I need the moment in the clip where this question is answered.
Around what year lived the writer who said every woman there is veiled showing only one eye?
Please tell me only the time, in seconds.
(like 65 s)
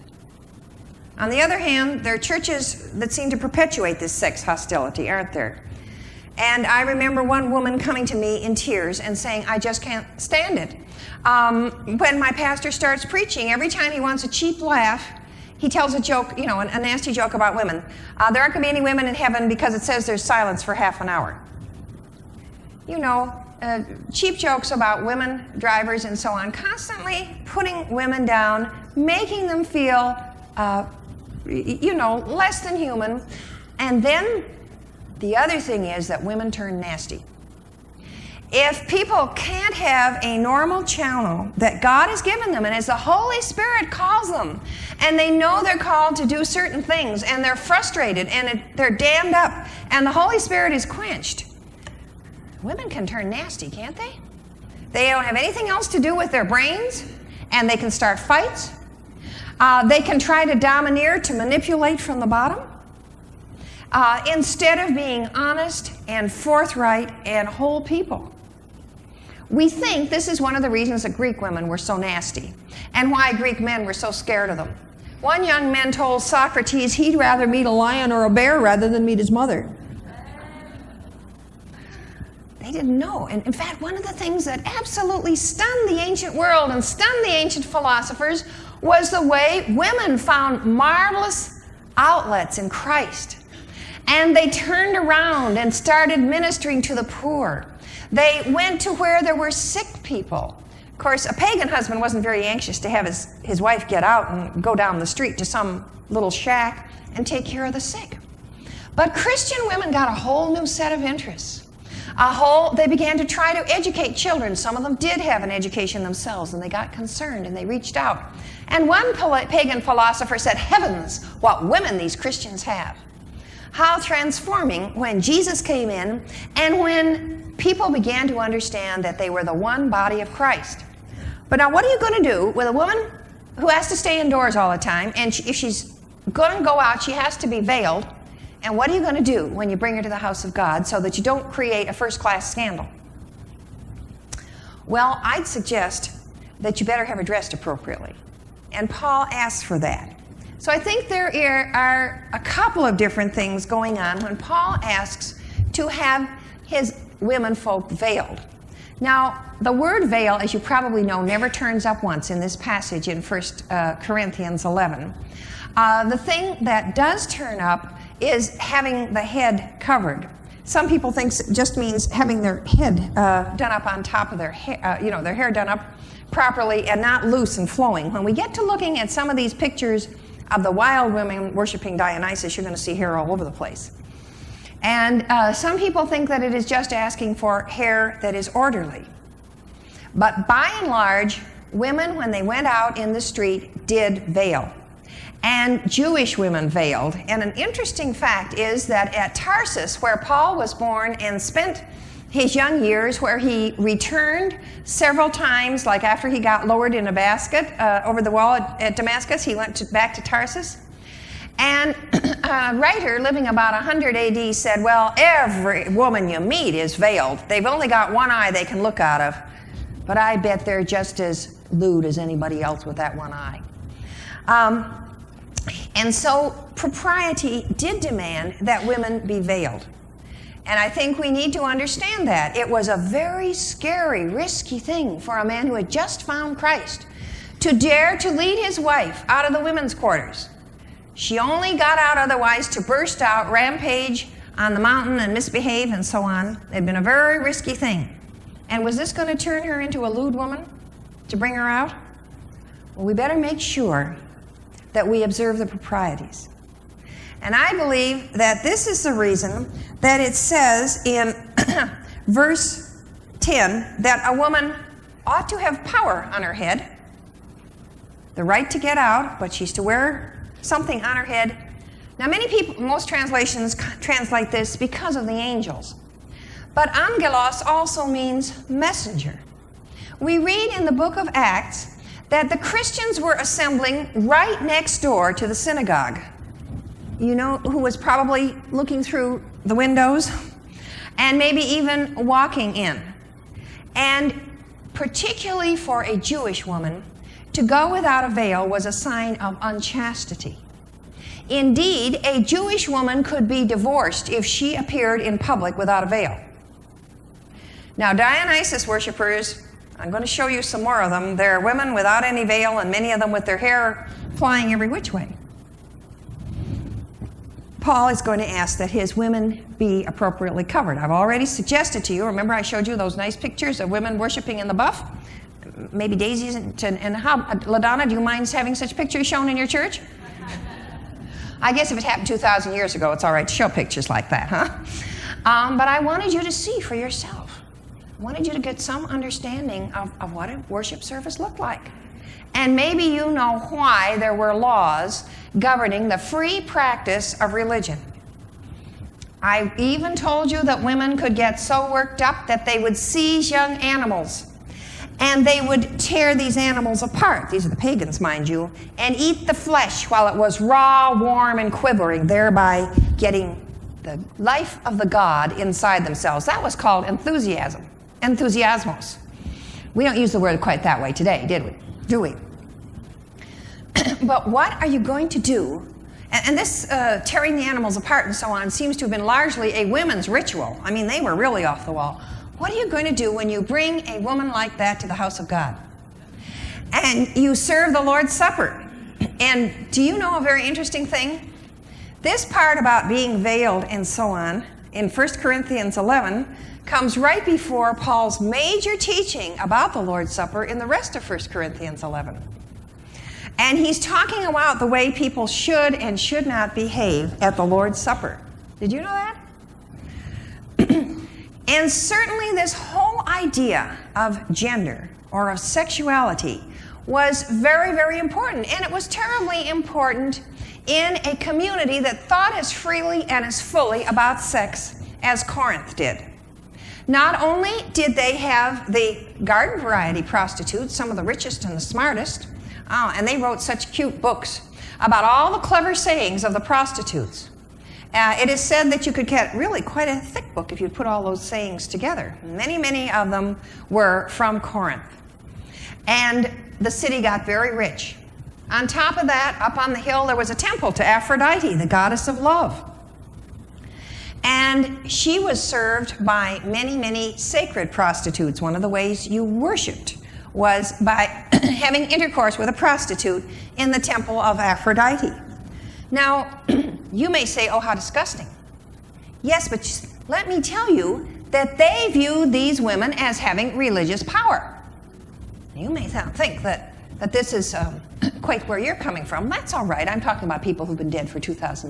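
213 s.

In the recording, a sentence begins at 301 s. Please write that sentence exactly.
Indeed, a Jewish woman could be divorced if she appeared in public without a veil.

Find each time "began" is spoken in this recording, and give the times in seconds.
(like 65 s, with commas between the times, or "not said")
112 s, 127 s.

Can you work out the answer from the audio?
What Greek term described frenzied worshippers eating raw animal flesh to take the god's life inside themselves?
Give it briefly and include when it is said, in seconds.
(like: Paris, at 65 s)
enthusiasmos, at 368 s.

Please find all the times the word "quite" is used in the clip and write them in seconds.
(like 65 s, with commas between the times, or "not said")
370 s, 439 s, 478 s.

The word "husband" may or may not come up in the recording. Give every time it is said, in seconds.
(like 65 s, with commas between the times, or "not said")
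101 s.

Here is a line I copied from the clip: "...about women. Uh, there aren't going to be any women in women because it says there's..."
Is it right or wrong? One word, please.
wrong.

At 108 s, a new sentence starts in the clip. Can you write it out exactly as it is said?
But Christian women got a whole new set of interests.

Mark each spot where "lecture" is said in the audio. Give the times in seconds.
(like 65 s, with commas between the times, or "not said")
not said.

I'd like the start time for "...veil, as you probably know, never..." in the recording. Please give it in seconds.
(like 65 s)
160 s.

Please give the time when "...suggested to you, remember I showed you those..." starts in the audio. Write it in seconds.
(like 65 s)
321 s.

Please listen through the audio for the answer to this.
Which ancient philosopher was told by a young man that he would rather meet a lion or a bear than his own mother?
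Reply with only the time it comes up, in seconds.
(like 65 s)
76 s.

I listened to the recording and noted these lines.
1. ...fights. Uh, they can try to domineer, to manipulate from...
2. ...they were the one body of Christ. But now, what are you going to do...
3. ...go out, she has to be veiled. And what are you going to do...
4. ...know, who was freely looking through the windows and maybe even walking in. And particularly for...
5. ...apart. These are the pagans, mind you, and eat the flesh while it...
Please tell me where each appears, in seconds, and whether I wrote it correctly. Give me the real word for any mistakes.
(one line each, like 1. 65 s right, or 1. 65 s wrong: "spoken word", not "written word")
1. 58 s right
2. 129 s right
3. 136 s right
4. 287 s wrong: "probably", not "freely"
5. 357 s right.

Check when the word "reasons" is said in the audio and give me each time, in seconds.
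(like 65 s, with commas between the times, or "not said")
70 s, 259 s.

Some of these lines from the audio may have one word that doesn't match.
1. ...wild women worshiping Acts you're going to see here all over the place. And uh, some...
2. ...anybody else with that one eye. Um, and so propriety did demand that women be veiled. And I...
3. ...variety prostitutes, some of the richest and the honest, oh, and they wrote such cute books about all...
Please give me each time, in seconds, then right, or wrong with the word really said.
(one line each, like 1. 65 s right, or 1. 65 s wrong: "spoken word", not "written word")
1. 180 s wrong: "Dionysus", not "Acts"
2. 222 s right
3. 429 s wrong: "smartest", not "honest".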